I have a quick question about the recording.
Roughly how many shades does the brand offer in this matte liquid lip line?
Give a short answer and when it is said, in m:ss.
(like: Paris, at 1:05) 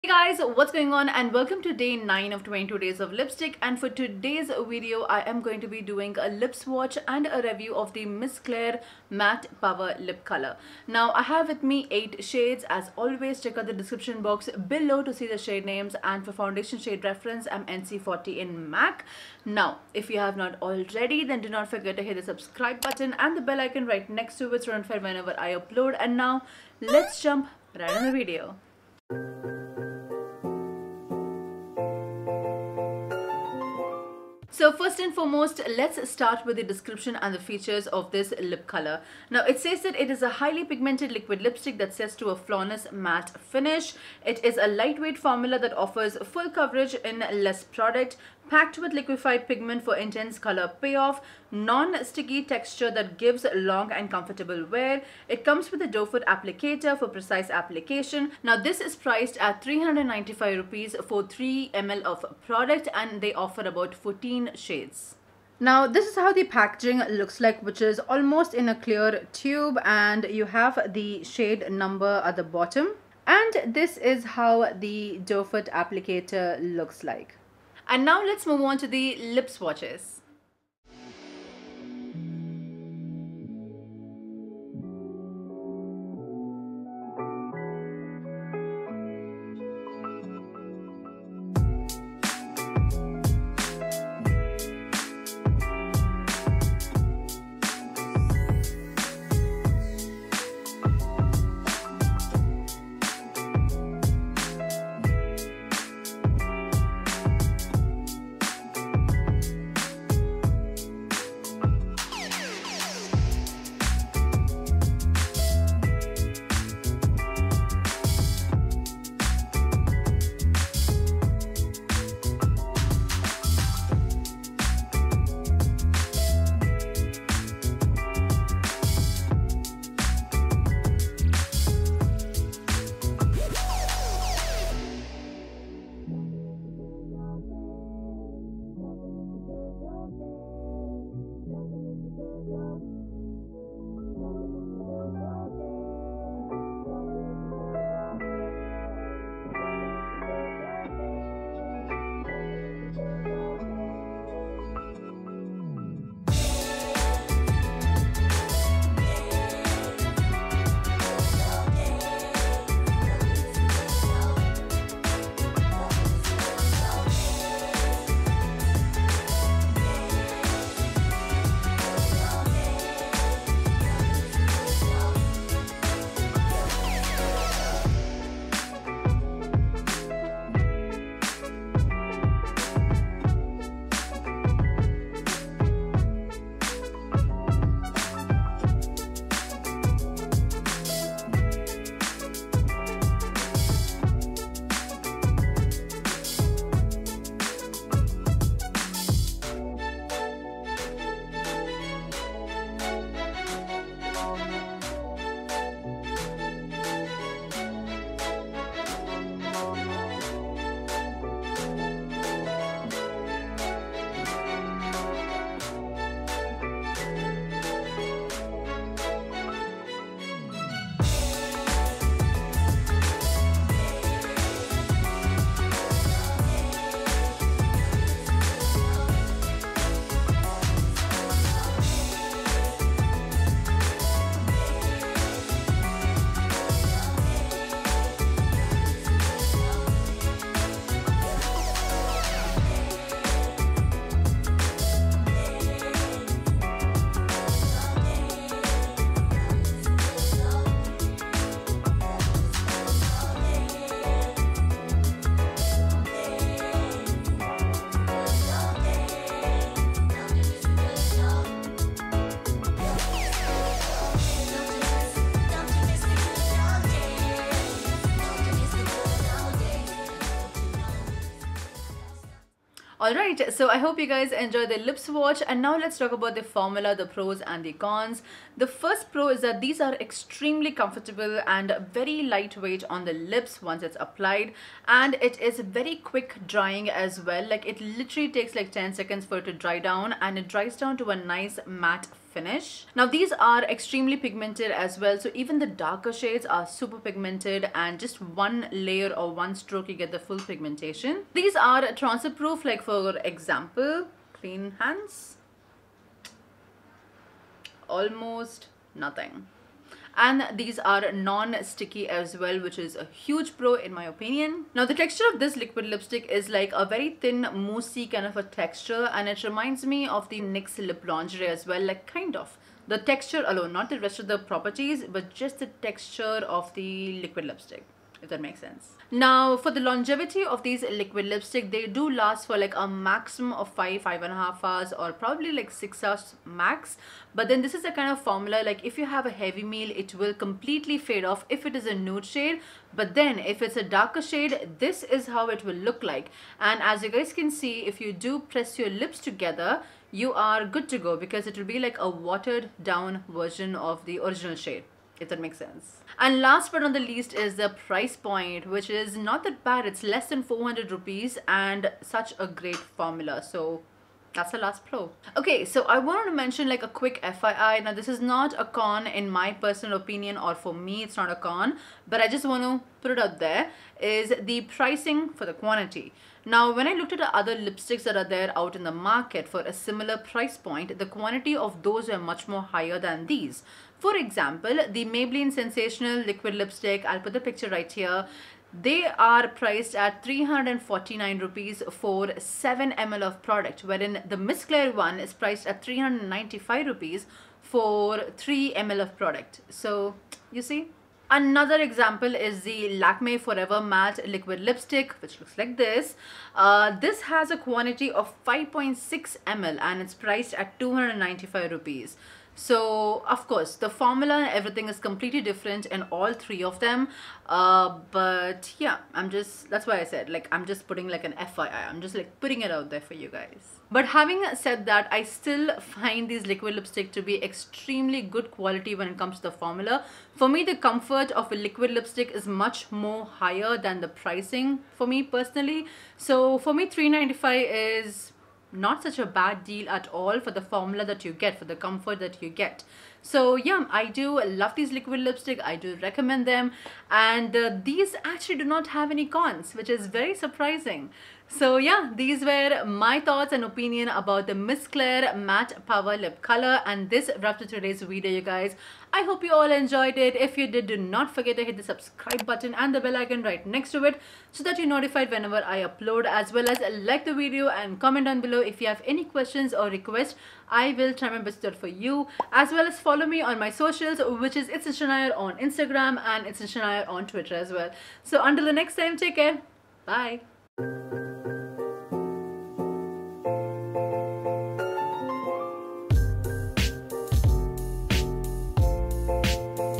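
14, at 1:03.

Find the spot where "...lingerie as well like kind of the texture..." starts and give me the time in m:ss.
5:21.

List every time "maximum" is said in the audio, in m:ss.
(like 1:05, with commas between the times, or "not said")
5:32.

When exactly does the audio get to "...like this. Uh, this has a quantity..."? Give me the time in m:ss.
6:45.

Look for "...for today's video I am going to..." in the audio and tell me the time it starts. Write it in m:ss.
0:03.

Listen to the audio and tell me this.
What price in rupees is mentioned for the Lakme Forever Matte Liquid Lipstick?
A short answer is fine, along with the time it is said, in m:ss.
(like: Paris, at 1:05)
295, at 6:50.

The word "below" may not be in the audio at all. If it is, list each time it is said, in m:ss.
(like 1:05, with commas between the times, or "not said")
0:14, 7:48.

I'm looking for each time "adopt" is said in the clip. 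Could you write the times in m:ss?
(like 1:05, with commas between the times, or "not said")
not said.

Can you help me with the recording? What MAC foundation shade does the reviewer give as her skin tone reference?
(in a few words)
NC40.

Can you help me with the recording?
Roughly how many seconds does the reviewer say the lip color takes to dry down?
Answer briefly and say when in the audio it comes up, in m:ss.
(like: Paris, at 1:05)
10, at 4:48.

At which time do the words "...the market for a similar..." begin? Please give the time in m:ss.
6:18.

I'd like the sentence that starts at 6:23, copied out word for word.
For example, the Maybelline Sensational Liquid Lipstick, I'll put the picture right here.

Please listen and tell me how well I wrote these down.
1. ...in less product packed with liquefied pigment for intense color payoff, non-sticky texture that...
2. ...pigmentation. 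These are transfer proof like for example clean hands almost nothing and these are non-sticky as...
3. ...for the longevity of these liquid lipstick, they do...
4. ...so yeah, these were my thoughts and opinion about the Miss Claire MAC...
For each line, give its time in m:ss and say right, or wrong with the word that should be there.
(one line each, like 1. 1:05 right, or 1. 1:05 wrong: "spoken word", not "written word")
1. 0:46 right
2. 5:00 right
3. 5:29 right
4. 7:31 wrong: "Matte", not "MAC".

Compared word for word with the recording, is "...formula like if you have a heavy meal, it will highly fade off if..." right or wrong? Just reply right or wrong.
wrong.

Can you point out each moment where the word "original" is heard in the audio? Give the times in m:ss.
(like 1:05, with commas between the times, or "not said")
5:54.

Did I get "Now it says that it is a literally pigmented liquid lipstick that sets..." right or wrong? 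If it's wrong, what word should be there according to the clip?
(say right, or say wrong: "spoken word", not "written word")
wrong: "highly", not "literally".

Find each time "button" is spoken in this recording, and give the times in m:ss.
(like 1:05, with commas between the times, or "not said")
0:22, 7:42.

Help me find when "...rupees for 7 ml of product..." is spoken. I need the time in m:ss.
6:31.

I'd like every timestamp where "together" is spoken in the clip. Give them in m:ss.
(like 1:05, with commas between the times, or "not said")
5:49.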